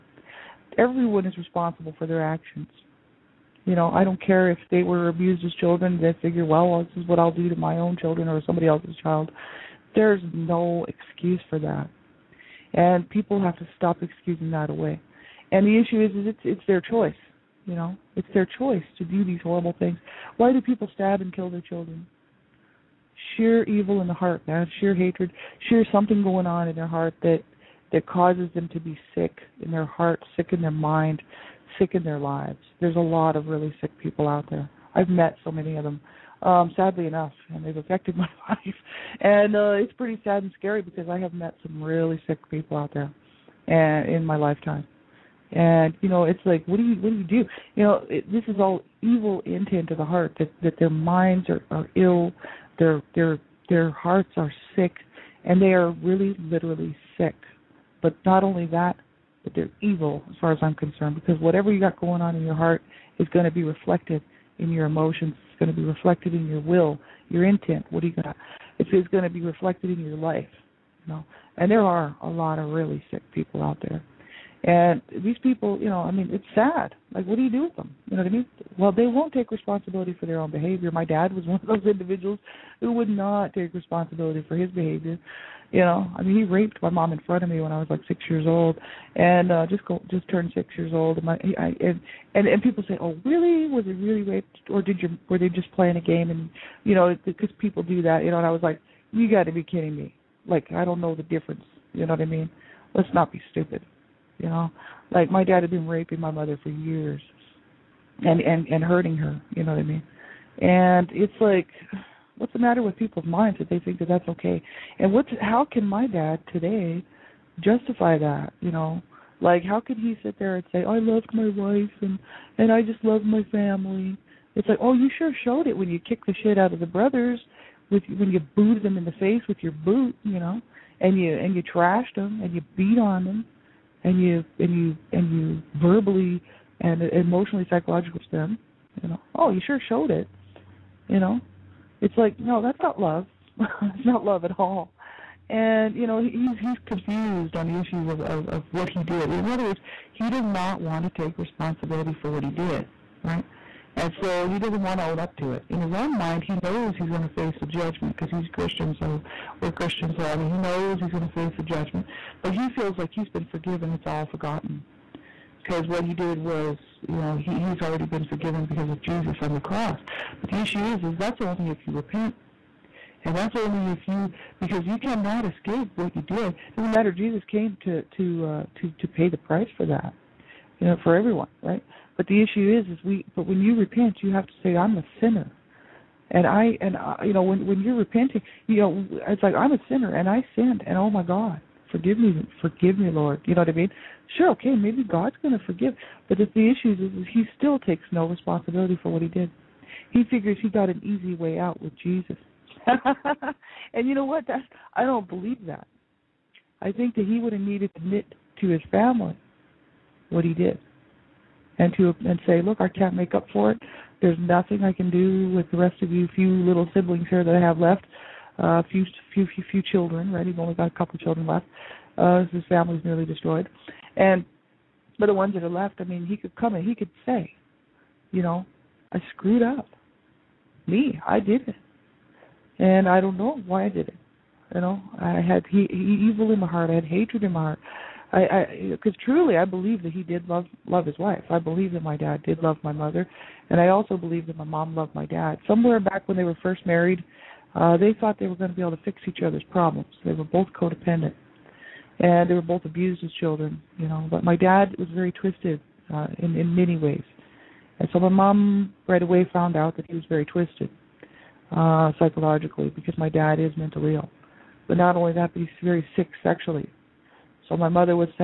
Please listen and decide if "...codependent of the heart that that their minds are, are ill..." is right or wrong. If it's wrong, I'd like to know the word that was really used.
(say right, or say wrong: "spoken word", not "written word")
wrong: "intent", not "codependent".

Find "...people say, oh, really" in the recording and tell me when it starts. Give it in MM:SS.
01:32.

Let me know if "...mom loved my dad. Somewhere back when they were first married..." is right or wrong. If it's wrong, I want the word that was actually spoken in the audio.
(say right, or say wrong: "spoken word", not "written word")
right.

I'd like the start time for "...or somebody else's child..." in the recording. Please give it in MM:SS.
00:08.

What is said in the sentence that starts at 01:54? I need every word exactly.
And what's how can my dad today justify that?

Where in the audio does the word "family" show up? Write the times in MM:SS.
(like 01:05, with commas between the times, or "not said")
02:03, 03:28, 03:42.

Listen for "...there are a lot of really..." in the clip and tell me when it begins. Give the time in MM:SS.
01:11.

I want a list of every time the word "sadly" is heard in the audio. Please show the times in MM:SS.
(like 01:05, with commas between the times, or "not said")
00:36.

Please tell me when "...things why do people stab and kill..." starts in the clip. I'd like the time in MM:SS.
00:19.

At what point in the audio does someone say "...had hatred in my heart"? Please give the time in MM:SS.
03:56.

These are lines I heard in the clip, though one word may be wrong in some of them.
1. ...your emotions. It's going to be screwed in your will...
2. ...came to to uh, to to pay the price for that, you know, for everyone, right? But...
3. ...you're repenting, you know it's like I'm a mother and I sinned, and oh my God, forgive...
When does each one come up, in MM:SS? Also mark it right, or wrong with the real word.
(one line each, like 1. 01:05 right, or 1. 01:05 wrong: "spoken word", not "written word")
1. 01:04 wrong: "reflected", not "screwed"
2. 02:57 right
3. 03:07 wrong: "sinner", not "mother".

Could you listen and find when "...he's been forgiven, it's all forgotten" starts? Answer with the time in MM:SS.
02:43.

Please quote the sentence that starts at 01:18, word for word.
Well, they won't take responsibility for their own behavior.